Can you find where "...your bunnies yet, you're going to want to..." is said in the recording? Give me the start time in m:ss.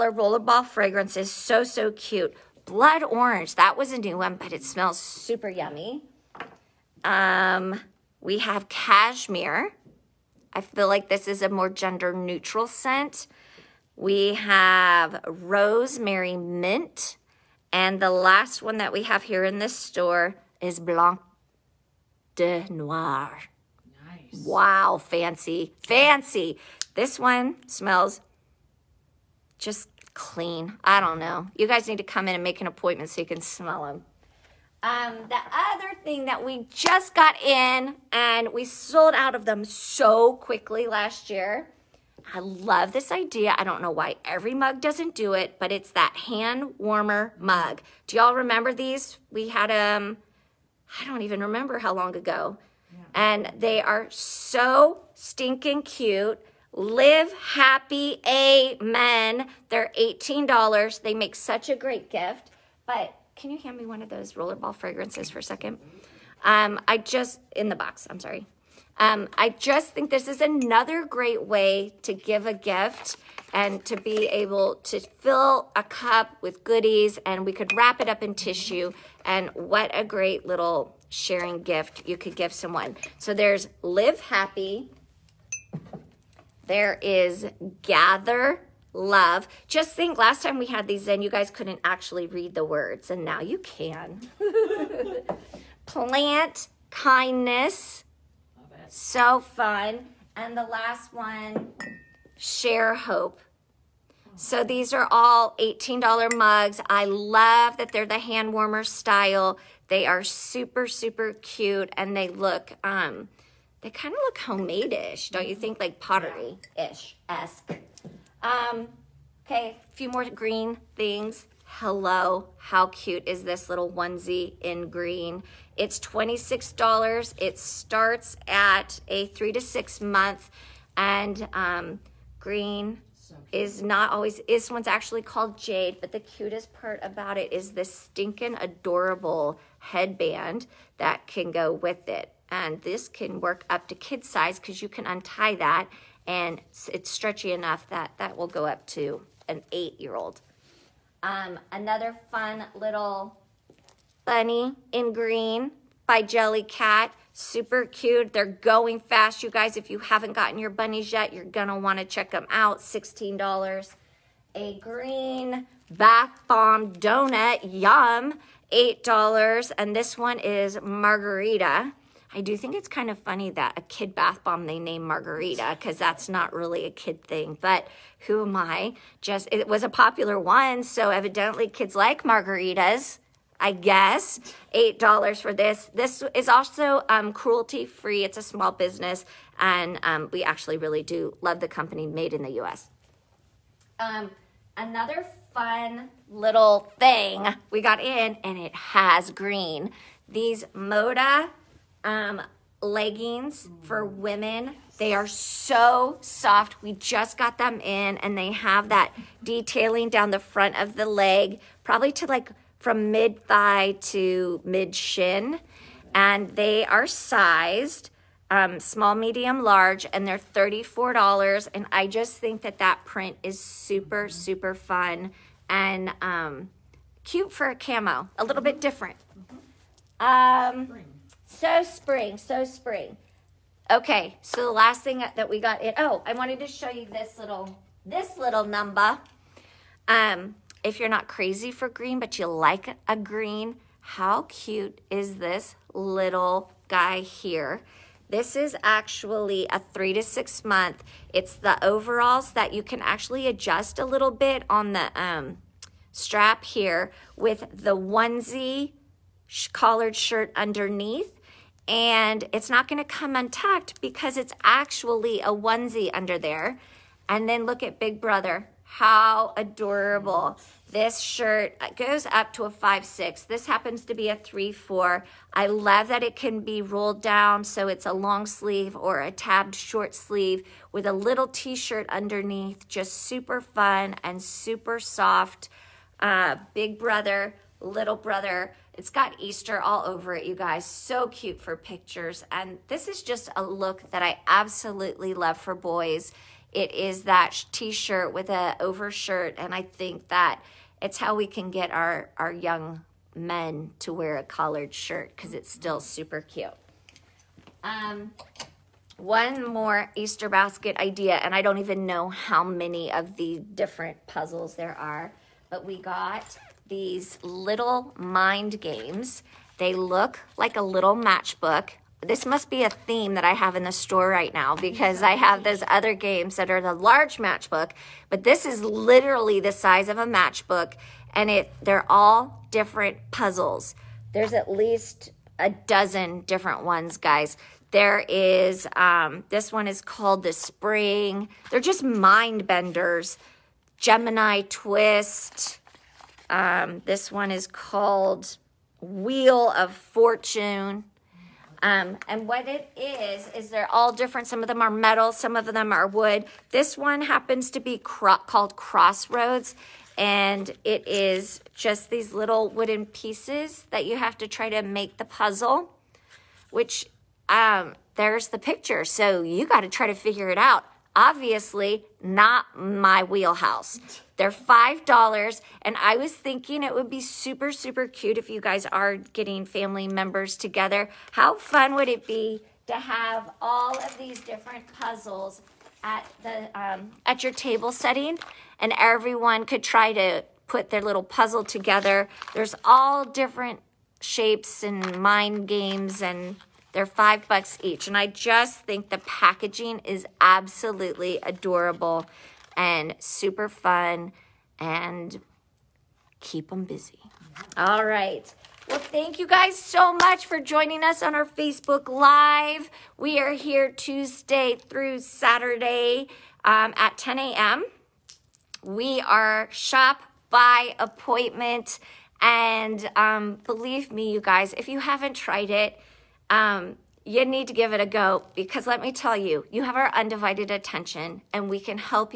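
2:40.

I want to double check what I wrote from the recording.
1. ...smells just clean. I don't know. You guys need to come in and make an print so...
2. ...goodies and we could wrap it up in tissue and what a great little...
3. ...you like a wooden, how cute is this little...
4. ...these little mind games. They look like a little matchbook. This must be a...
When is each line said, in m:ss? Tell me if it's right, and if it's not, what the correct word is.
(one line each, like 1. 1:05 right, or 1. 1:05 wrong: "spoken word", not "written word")
1. 0:27 wrong: "appointment", not "print"
2. 1:16 right
3. 4:02 wrong: "green", not "wooden"
4. 5:16 right.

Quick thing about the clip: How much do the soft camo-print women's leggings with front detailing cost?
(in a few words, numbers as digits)
$34.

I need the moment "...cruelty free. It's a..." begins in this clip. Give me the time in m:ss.
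3:07.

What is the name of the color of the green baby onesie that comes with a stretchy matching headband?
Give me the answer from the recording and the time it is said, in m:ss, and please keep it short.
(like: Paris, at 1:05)
Jade, at 2:15.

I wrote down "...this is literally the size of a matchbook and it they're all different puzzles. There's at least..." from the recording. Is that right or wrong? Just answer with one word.
right.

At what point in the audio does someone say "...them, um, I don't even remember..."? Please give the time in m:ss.
0:49.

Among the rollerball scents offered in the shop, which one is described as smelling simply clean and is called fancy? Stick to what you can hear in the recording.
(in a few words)
Blanc de Noir.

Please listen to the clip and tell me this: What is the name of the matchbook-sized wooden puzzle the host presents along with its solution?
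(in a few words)
Crossroads.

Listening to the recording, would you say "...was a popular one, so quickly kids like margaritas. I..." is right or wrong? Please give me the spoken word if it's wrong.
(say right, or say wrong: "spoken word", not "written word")
wrong: "evidently", not "quickly".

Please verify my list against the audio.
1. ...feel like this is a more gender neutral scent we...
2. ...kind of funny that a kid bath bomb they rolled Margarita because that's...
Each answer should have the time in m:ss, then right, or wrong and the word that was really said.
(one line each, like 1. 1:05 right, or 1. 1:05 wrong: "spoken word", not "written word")
1. 0:10 right
2. 2:52 wrong: "named", not "rolled".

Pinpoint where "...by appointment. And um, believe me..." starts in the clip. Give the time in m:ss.
7:00.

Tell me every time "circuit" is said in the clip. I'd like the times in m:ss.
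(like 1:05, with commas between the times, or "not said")
not said.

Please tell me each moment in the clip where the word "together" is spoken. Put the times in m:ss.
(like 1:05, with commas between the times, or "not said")
6:20, 6:31.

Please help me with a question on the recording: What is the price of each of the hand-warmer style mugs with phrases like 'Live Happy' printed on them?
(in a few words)
$18.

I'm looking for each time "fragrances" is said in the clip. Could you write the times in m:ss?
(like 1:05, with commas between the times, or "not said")
0:00, 1:04.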